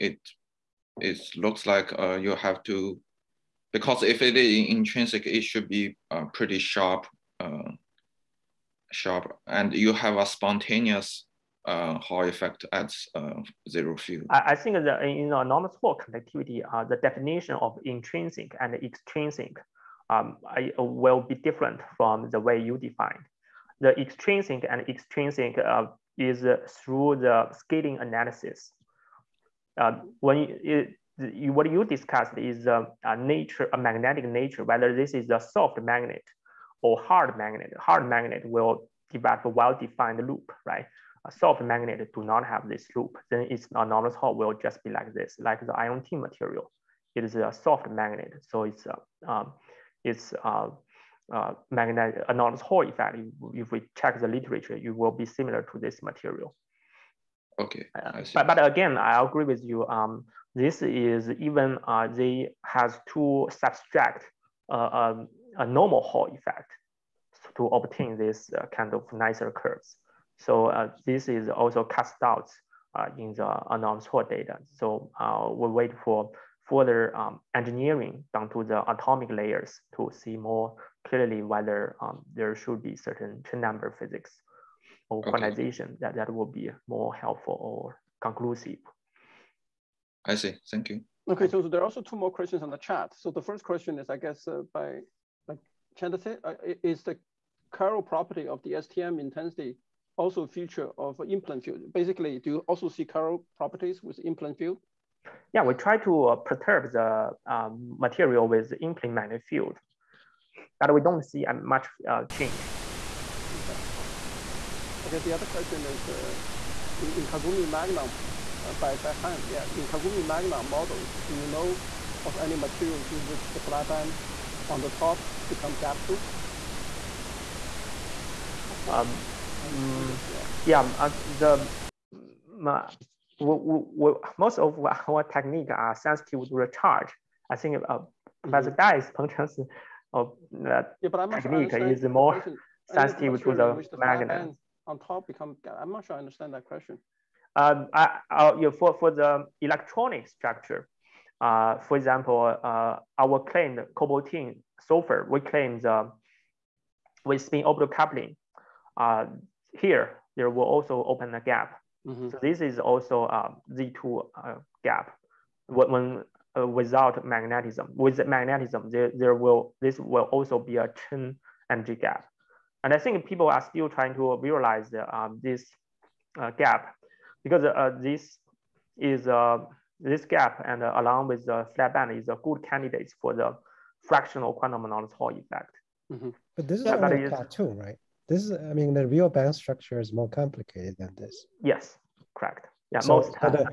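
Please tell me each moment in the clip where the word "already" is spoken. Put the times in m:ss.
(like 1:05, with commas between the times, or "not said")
not said.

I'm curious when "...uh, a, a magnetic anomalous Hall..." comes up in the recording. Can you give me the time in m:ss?
0:50.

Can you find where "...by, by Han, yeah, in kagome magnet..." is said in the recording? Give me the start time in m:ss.
1:58.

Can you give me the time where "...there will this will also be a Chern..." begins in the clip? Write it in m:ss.
2:49.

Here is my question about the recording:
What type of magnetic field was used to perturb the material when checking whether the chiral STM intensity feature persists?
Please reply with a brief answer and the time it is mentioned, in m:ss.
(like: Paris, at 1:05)
in-plane magnetic field, at 1:48.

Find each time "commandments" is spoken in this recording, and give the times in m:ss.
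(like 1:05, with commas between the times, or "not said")
not said.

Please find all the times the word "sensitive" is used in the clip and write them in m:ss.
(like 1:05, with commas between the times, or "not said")
2:15, 2:22.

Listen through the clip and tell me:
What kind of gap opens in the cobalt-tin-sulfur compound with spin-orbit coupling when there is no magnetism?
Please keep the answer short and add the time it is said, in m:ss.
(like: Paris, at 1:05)
Z2 gap, at 2:43.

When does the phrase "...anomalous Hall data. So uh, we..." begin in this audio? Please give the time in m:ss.
1:13.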